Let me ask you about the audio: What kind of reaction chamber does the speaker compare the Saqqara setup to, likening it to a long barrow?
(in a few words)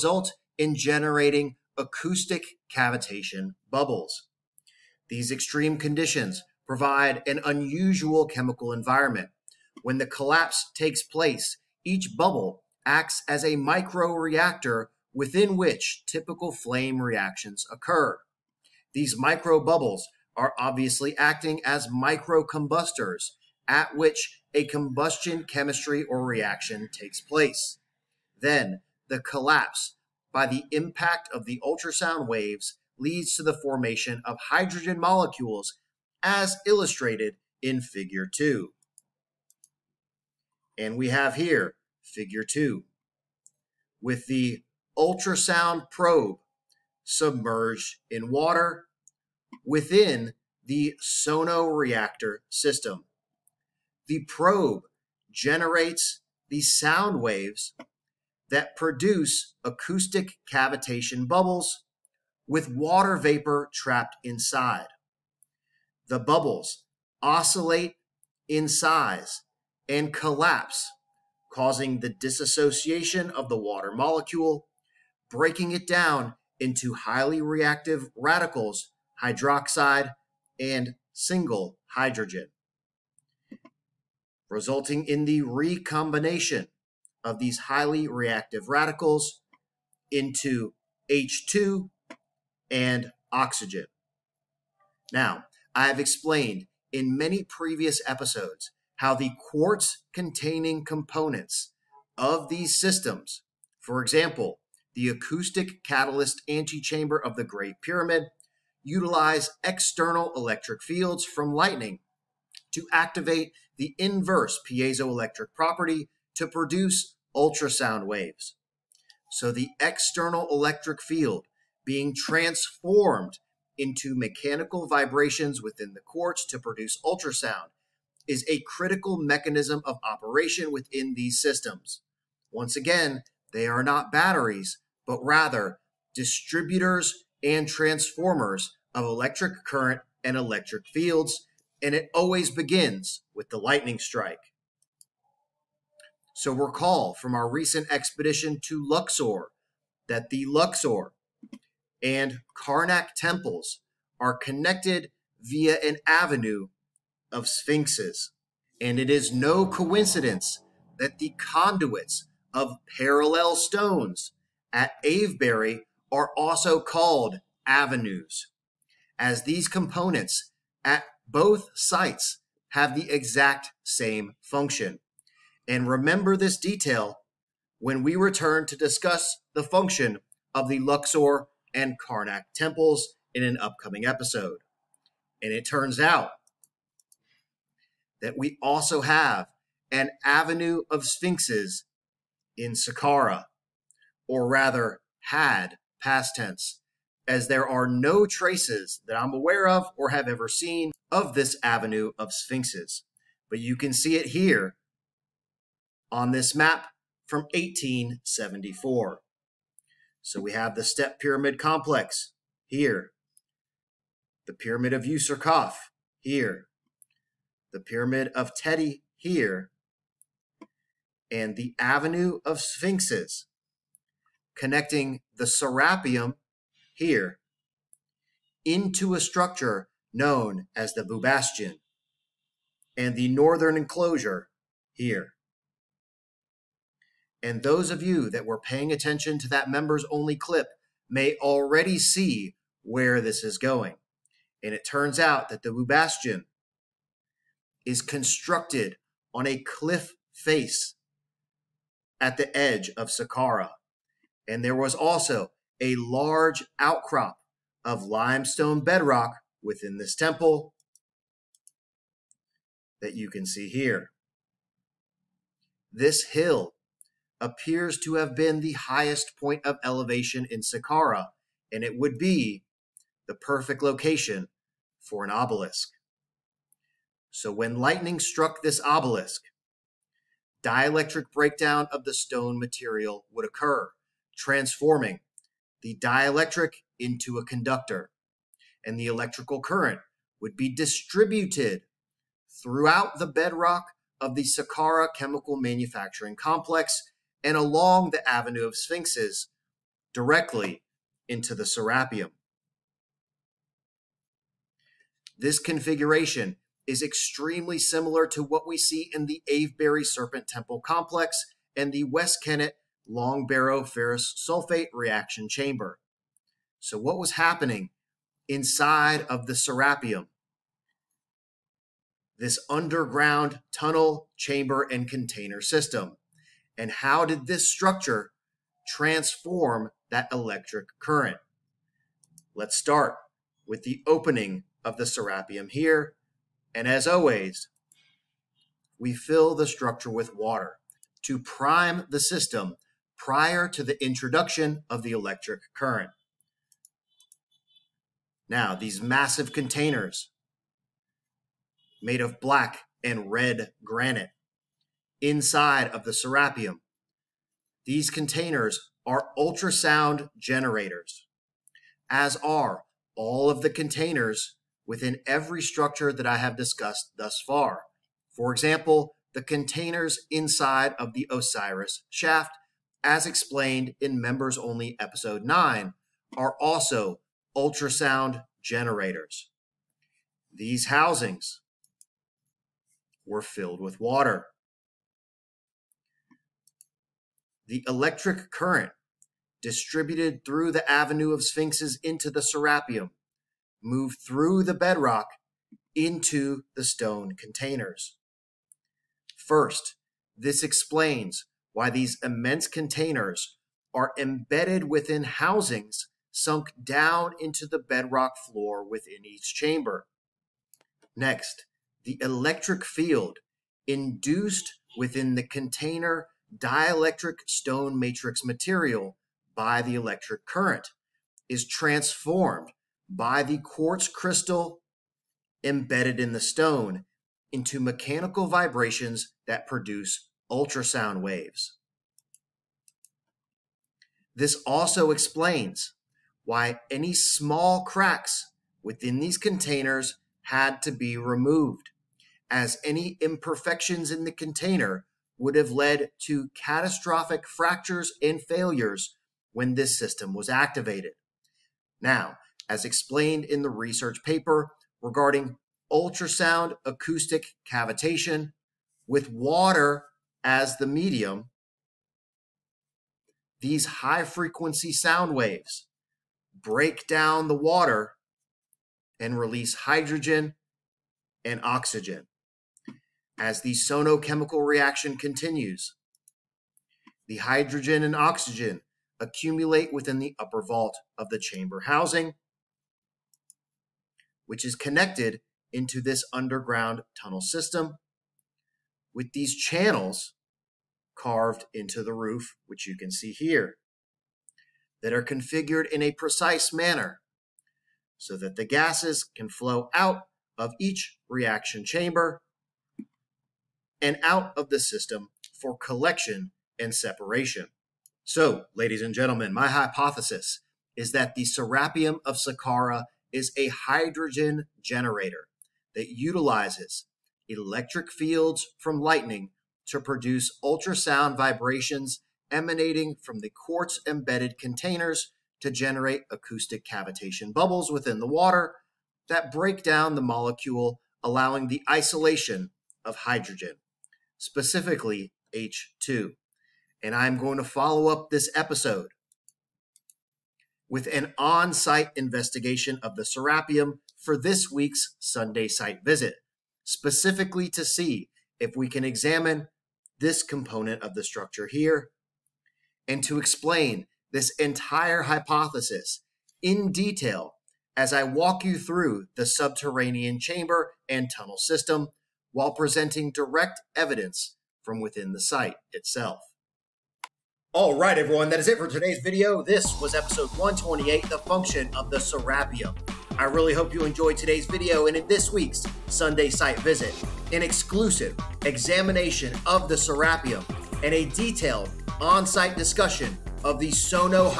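Ferrous sulfate.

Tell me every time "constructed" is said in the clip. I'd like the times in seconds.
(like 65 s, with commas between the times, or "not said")
248 s.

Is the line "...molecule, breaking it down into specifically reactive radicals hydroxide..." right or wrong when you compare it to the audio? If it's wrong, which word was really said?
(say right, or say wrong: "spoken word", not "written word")
wrong: "highly", not "specifically".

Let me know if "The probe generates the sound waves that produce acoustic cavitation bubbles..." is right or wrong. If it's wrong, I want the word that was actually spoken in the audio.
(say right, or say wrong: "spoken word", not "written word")
right.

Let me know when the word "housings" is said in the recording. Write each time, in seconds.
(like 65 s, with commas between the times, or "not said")
380 s, 405 s, 481 s.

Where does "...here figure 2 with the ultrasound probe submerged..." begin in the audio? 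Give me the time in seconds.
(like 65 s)
41 s.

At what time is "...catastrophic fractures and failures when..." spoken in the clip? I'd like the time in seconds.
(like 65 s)
446 s.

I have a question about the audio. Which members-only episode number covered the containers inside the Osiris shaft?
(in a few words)
9.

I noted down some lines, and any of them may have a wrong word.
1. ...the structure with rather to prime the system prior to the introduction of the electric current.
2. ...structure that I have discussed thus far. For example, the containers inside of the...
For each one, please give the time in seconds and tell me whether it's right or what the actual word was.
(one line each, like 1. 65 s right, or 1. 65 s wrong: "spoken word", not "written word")
1. 339 s wrong: "water", not "rather"
2. 365 s right.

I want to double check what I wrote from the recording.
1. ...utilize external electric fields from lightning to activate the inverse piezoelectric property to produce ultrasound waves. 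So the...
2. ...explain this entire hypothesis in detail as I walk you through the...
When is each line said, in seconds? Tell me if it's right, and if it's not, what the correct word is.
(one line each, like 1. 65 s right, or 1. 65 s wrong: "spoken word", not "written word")
1. 108 s right
2. 553 s right.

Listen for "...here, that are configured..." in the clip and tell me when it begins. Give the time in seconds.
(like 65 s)
493 s.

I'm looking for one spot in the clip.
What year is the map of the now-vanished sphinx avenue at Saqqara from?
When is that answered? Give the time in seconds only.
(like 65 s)
207 s.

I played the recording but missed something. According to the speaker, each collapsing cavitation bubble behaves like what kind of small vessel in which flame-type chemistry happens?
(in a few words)
Microreactor.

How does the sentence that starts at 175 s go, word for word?
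And remember this detail when we return to discuss the function of the Luxor and Karnak temples in an upcoming episode.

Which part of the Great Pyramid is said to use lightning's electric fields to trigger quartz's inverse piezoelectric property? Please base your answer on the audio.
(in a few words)
Acoustic catalyst antechamber.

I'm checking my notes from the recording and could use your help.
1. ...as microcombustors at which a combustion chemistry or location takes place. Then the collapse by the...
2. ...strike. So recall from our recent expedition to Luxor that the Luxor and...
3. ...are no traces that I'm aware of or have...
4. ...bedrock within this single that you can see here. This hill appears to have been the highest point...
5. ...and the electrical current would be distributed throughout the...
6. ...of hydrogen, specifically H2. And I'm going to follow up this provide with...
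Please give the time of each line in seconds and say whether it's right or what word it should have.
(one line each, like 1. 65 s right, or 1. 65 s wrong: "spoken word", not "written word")
1. 21 s wrong: "reaction", not "location"
2. 143 s right
3. 197 s right
4. 258 s wrong: "temple", not "single"
5. 288 s right
6. 533 s wrong: "episode", not "provide".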